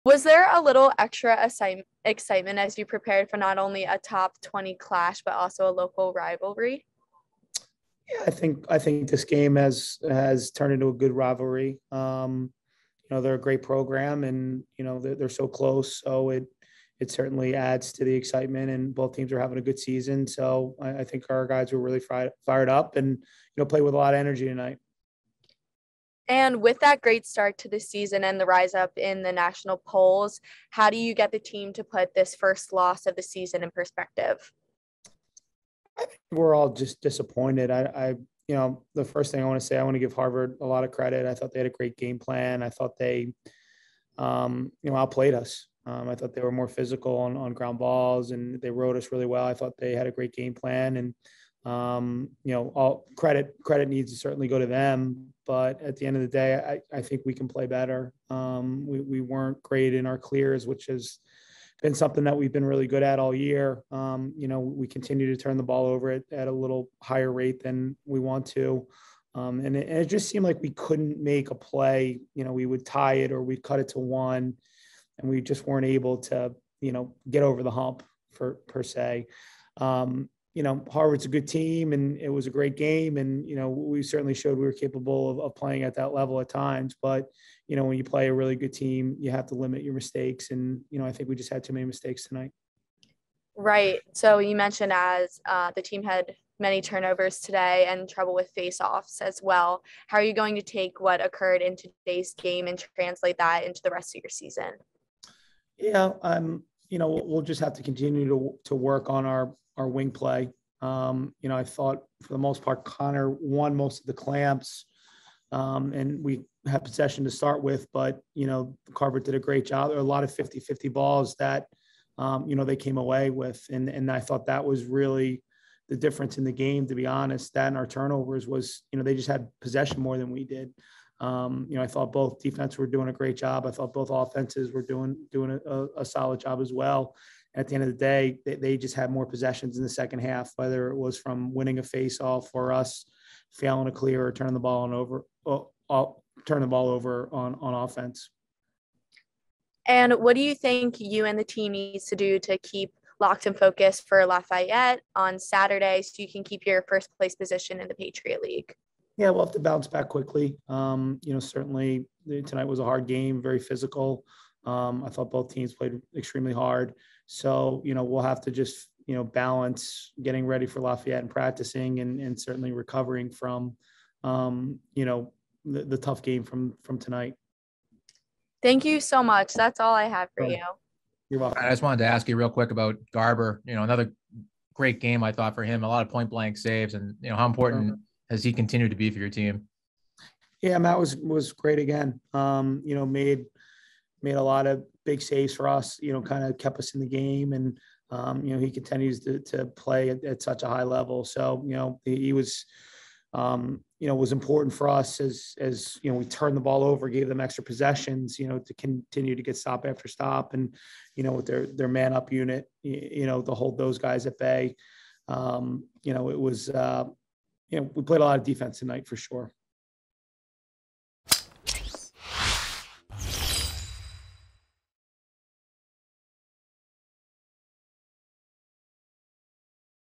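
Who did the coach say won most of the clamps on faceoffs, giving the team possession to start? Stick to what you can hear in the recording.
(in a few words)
Connor.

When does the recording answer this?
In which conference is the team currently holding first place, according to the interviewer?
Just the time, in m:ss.
2:37.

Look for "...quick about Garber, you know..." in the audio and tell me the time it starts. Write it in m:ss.
3:02.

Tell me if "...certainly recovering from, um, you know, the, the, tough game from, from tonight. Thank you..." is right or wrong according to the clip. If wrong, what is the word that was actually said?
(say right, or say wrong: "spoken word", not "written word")
right.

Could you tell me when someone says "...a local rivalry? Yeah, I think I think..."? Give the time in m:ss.
0:05.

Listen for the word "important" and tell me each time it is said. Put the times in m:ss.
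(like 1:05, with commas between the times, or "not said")
3:07, 3:24.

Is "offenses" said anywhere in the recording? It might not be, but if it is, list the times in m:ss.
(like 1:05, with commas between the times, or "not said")
2:14, 2:27.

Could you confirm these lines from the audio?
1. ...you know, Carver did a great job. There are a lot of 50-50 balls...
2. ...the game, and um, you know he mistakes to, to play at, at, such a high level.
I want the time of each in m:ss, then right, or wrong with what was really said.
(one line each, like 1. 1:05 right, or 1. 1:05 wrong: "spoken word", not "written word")
1. 1:58 right
2. 3:16 wrong: "continues", not "mistakes".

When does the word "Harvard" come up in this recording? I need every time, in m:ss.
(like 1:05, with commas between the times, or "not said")
0:40, 1:20.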